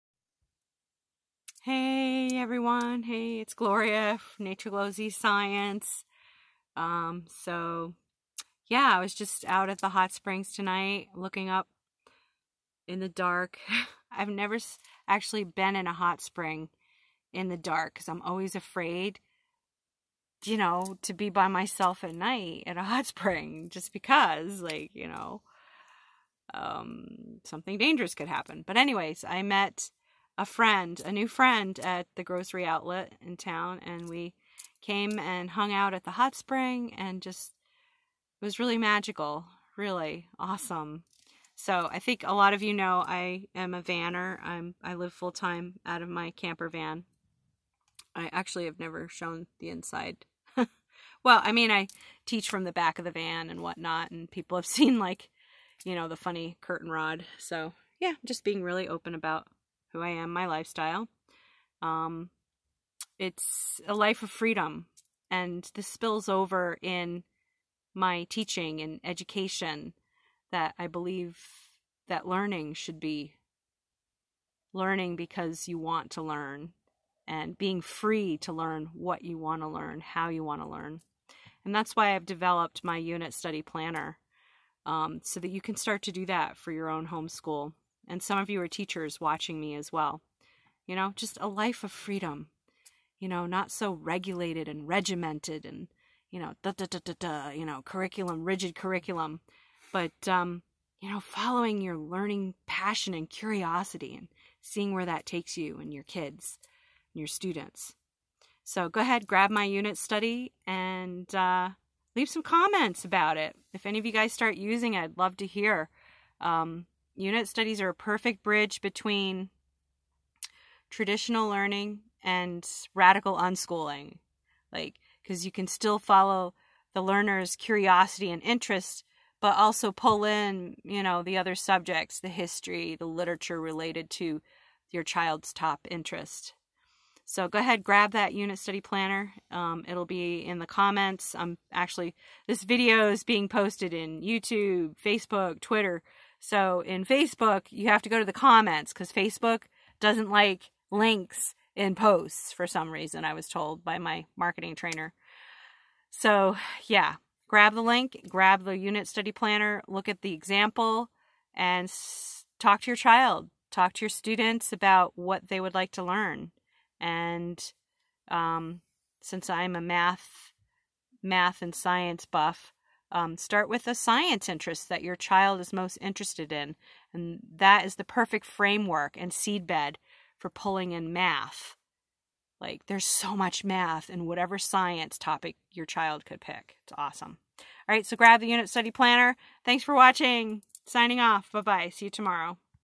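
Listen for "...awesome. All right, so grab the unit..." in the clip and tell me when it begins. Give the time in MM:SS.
03:06.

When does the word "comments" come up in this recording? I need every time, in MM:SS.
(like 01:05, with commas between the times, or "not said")
01:52, 02:20, 02:28.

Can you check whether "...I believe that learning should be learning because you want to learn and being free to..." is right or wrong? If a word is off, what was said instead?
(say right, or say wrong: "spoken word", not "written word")
right.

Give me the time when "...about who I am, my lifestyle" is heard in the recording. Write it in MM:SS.
00:59.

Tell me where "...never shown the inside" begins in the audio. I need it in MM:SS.
00:48.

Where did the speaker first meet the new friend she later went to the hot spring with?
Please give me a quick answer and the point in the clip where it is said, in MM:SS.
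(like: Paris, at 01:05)
Grocery outlet, at 00:32.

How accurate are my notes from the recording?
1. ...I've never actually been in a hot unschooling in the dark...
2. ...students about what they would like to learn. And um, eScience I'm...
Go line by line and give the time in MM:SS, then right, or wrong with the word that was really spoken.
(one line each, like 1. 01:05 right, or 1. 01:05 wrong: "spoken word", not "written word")
1. 00:14 wrong: "spring", not "unschooling"
2. 02:44 wrong: "since", not "eScience".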